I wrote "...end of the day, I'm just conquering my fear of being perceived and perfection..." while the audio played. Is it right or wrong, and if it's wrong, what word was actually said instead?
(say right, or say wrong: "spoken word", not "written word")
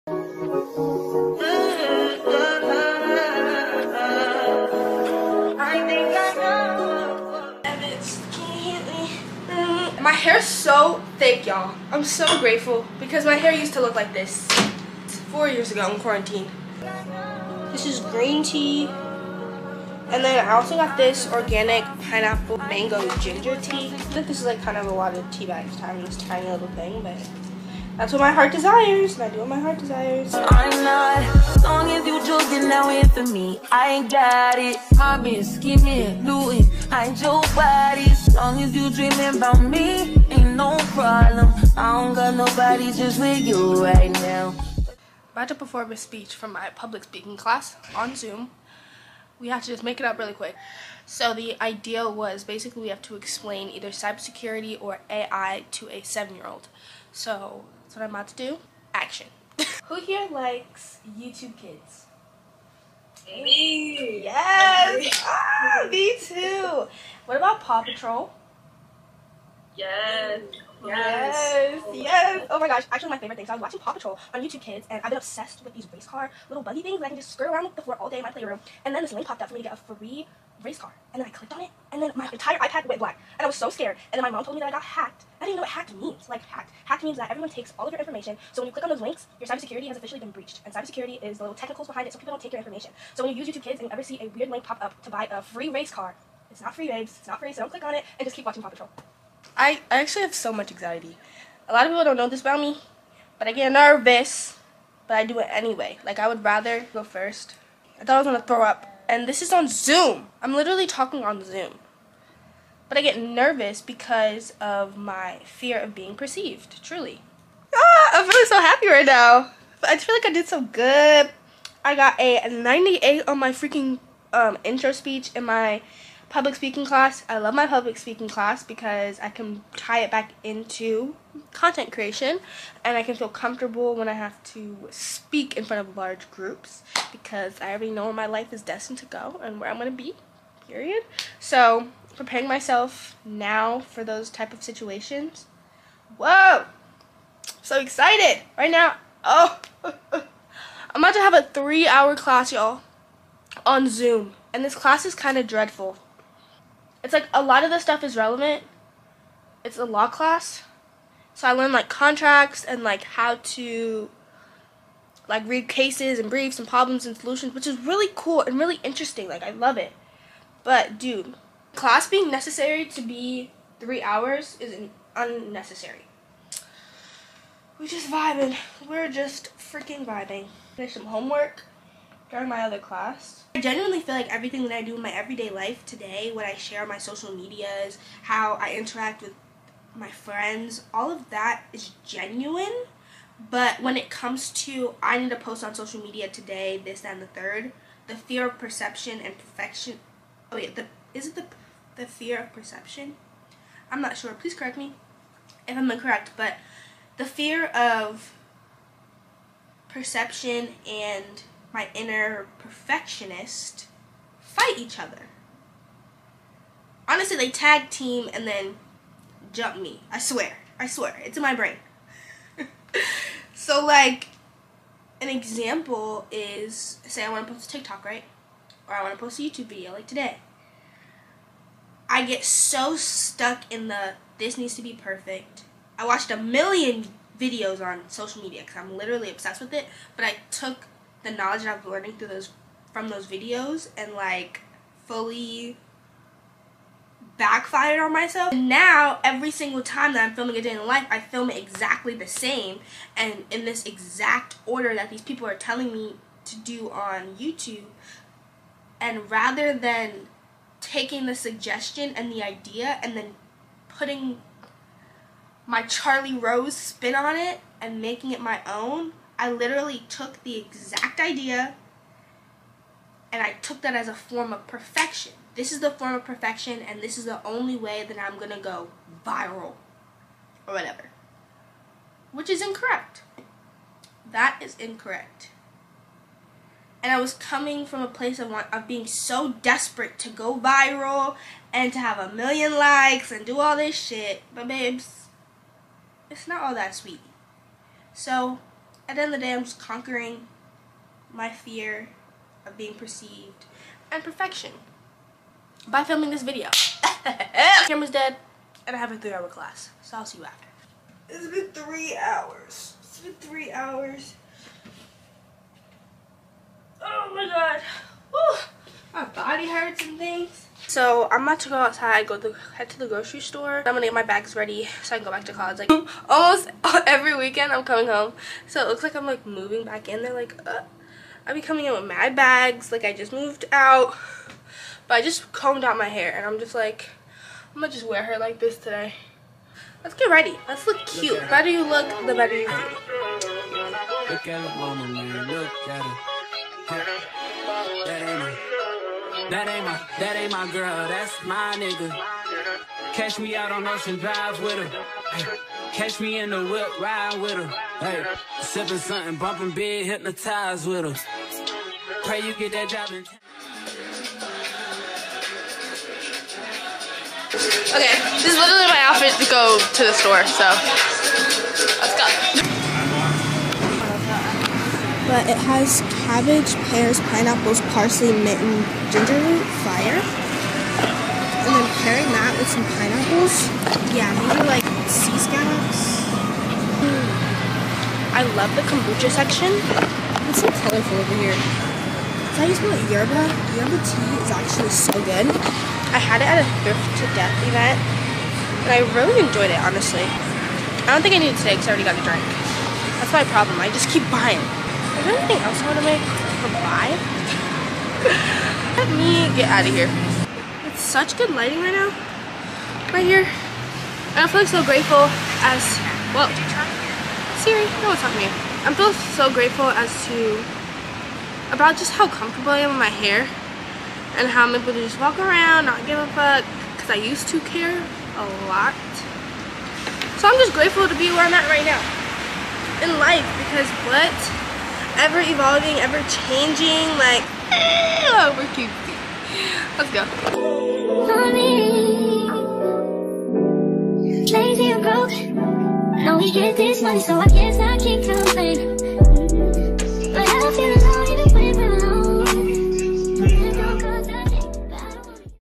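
right.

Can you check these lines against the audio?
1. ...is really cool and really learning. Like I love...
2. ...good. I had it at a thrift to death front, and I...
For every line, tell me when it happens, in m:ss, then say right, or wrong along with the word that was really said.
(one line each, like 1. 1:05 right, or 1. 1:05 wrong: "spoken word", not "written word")
1. 2:47 wrong: "interesting", not "learning"
2. 6:35 wrong: "event", not "front".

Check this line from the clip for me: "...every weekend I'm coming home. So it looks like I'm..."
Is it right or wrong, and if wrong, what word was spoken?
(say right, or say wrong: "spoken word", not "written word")
right.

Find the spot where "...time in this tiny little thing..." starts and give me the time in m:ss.
0:25.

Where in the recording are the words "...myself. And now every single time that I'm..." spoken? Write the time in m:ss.
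4:08.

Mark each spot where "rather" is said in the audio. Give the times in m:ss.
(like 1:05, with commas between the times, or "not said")
1:46, 4:19.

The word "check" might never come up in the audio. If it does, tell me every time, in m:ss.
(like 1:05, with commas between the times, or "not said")
not said.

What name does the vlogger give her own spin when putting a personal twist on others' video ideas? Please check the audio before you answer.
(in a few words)
Charli Rose.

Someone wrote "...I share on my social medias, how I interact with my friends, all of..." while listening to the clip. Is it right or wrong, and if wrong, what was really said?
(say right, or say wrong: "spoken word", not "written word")
right.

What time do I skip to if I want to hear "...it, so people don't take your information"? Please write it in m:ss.
1:32.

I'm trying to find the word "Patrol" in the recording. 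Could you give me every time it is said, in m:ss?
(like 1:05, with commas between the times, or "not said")
1:07, 1:13, 1:38.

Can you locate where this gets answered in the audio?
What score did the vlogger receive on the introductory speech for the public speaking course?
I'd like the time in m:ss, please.
2:02.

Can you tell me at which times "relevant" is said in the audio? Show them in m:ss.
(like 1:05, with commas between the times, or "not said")
2:38.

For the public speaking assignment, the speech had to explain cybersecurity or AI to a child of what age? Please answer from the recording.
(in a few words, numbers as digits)
7.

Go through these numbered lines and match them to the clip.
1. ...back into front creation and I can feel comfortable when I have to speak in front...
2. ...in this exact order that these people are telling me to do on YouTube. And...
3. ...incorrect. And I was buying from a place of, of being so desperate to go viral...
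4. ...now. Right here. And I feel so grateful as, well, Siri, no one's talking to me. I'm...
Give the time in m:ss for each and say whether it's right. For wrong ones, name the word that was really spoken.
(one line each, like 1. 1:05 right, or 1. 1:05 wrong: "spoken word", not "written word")
1. 2:10 wrong: "content", not "front"
2. 4:13 right
3. 4:44 wrong: "coming", not "buying"
4. 6:51 right.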